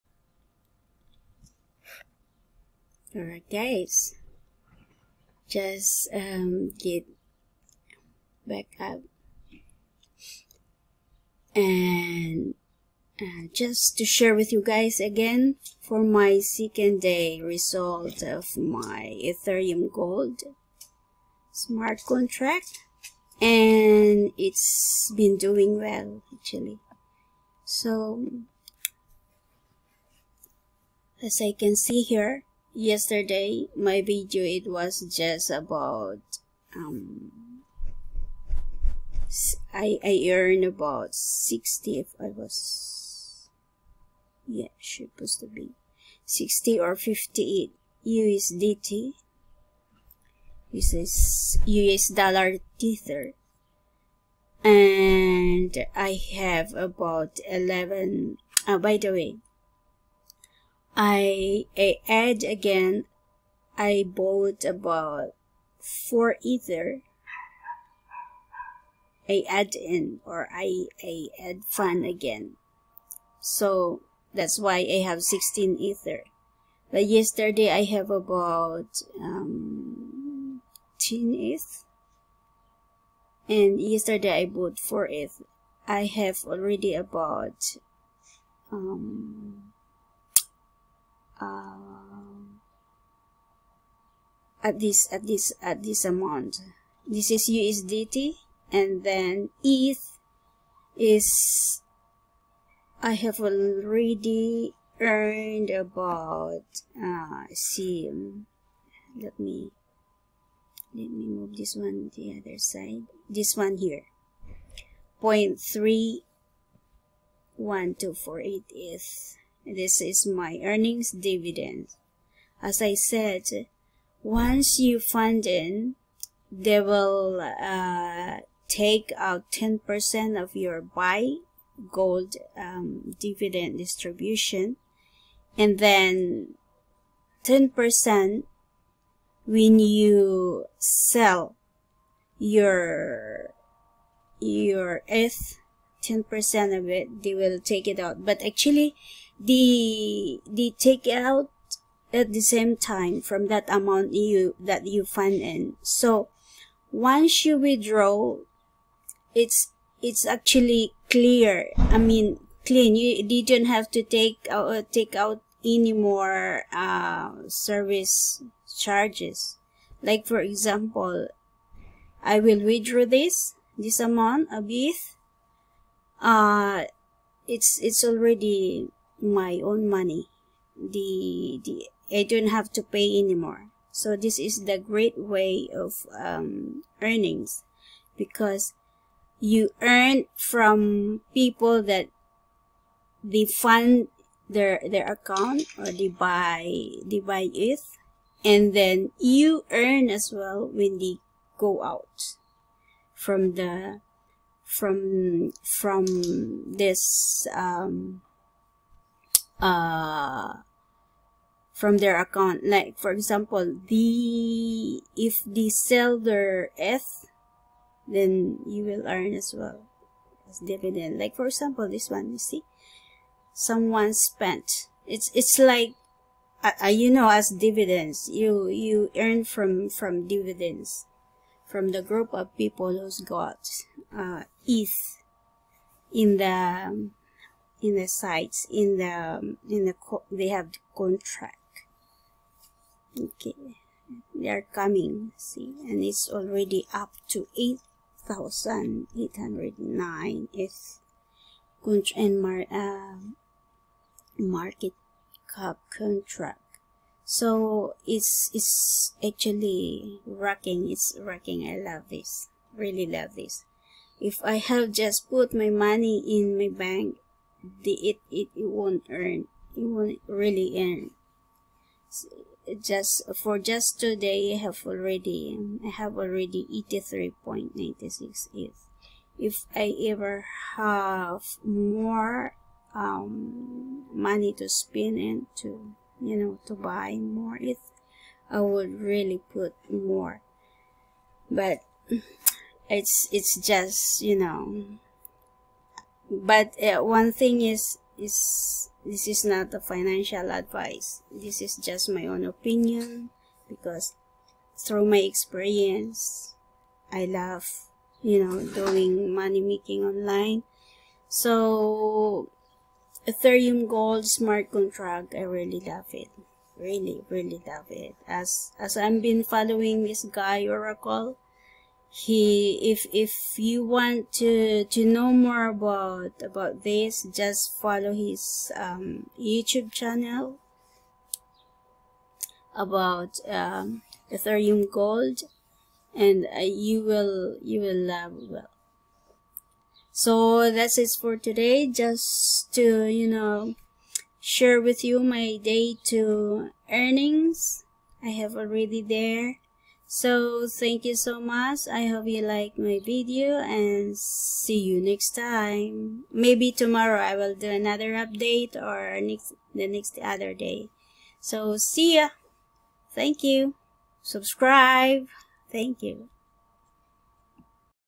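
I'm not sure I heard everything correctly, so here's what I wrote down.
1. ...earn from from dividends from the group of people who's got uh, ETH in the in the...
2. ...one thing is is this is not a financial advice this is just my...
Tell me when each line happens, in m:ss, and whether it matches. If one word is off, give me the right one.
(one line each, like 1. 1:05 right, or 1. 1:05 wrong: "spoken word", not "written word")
1. 3:49 right
2. 4:57 right.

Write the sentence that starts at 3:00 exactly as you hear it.
The, the I don't have to pay anymore.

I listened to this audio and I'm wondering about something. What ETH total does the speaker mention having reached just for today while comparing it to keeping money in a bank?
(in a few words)
83.96 ETH.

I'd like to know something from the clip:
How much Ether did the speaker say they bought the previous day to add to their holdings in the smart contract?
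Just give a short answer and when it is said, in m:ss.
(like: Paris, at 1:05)
4 ETH, at 1:24.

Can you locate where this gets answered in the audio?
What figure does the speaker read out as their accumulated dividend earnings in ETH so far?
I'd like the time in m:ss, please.
1:55.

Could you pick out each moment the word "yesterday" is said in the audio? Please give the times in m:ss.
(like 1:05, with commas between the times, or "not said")
0:32, 1:17, 1:23.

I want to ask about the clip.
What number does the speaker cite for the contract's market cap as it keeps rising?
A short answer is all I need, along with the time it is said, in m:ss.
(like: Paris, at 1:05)
8809, at 4:07.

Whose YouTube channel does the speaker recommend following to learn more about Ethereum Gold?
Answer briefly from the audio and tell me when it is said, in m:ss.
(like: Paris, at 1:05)
Oracle, at 5:20.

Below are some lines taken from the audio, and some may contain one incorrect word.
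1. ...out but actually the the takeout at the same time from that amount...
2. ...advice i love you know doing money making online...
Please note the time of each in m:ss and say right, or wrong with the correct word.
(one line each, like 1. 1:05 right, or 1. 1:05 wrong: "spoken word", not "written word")
1. 2:27 right
2. 5:05 wrong: "experience", not "advice".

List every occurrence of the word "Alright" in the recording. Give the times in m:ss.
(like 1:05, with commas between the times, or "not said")
0:03.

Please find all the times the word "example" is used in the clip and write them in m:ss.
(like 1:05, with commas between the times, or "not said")
2:50, 3:33, 3:41.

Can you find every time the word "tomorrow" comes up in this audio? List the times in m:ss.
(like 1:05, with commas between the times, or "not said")
5:56.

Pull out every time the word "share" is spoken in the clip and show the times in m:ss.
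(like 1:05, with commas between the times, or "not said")
0:14, 5:44.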